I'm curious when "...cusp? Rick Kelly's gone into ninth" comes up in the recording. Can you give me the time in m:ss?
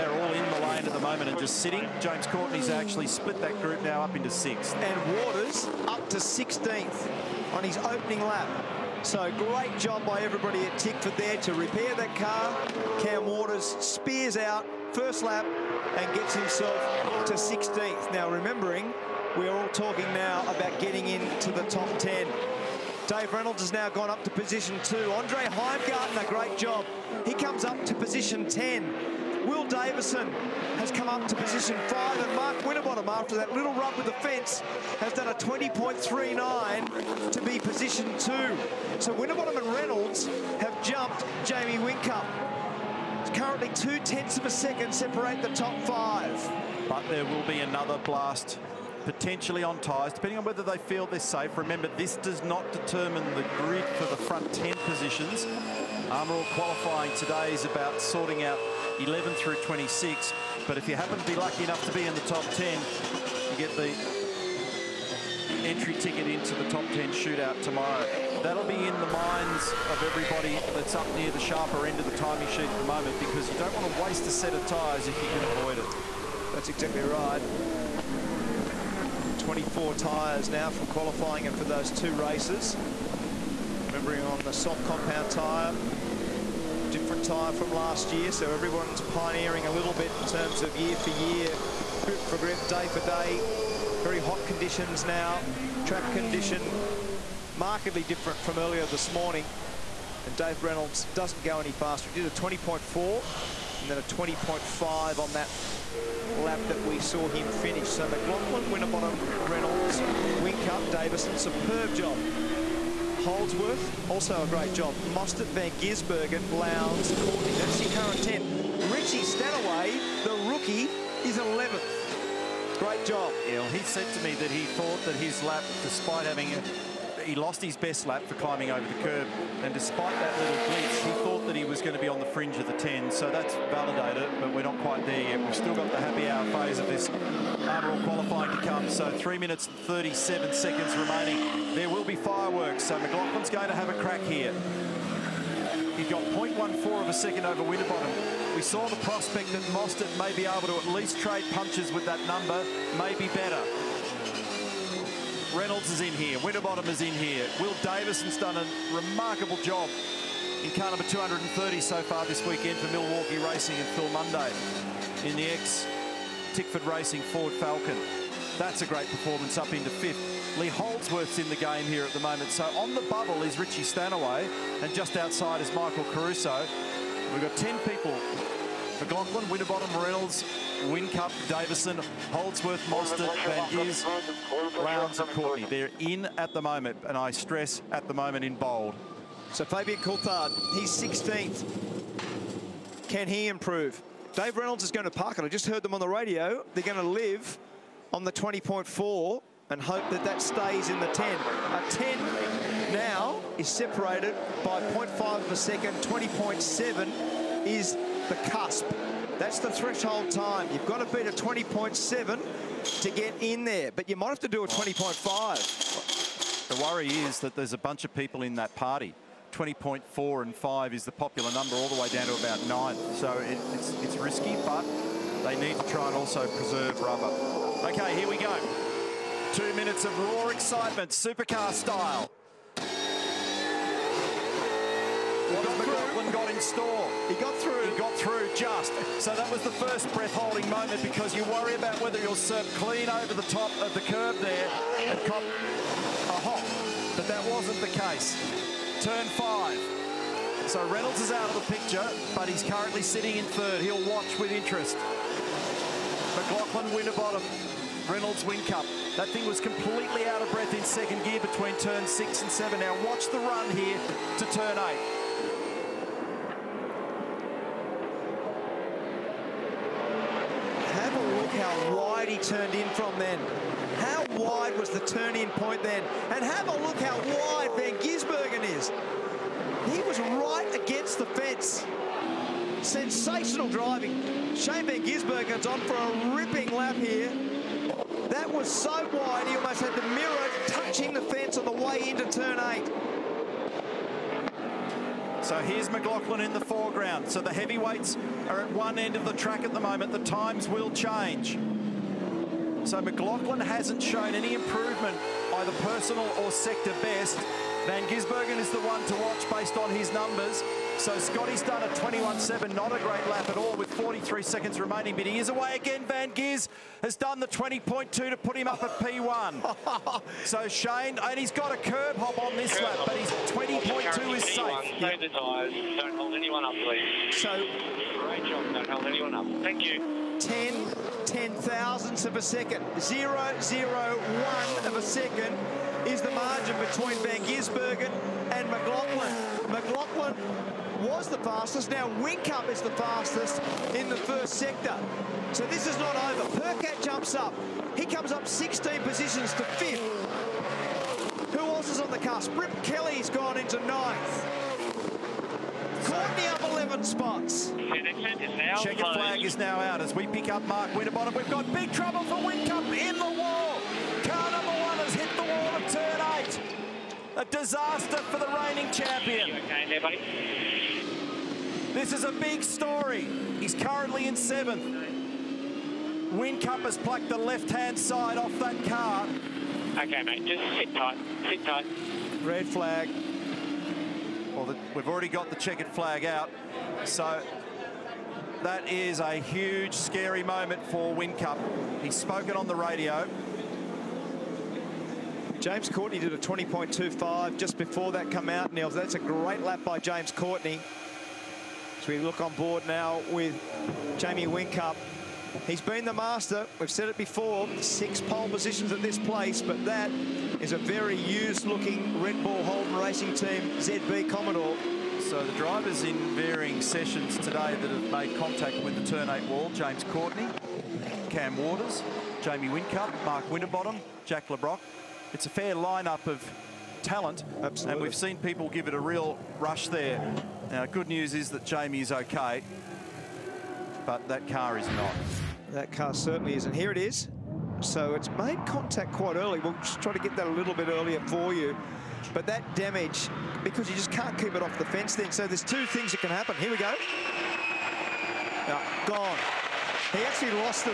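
5:52.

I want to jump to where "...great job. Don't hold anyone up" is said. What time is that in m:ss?
5:28.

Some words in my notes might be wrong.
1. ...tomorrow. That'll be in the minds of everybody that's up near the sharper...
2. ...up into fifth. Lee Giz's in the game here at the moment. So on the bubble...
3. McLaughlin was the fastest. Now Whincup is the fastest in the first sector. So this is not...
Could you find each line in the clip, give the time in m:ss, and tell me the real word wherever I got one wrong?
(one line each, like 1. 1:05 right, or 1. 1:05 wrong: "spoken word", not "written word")
1. 1:07 right
2. 2:49 wrong: "Holdsworth", not "Giz"
3. 5:39 right.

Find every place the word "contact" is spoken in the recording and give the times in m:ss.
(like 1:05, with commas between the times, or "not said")
6:58, 7:18.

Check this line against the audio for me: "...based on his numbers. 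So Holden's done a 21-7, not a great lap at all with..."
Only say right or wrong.
wrong.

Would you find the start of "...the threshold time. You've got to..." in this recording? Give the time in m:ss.
3:29.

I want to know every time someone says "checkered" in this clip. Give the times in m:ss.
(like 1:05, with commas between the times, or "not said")
5:58, 6:25.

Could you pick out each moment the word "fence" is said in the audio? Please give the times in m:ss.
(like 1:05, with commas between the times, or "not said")
0:34, 4:41, 4:51, 7:24.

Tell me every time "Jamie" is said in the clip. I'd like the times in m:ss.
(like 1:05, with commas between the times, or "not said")
0:41, 6:44, 7:02, 7:11.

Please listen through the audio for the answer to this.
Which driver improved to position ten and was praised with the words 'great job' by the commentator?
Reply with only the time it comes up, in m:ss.
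0:25.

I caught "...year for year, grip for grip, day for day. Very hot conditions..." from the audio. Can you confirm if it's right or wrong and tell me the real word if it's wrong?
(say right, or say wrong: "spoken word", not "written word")
right.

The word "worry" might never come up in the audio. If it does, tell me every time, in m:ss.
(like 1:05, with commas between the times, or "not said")
3:36, 4:01.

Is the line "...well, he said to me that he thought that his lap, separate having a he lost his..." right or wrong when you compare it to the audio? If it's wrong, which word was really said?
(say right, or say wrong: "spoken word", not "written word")
wrong: "despite", not "separate".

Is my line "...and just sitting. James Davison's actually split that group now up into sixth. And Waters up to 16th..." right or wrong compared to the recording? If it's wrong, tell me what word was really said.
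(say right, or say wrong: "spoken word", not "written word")
wrong: "Courtney", not "Davison".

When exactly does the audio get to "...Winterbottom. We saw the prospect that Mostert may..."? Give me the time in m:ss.
2:27.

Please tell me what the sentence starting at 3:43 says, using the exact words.
So it, it's, it's risky, but they need to try and also preserve rubber.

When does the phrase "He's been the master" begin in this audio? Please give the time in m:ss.
6:45.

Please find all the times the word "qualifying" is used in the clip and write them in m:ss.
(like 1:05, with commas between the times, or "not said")
0:56, 1:20, 2:18.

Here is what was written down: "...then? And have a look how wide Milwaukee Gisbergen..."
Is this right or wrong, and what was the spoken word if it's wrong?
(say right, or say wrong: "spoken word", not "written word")
wrong: "Van", not "Milwaukee".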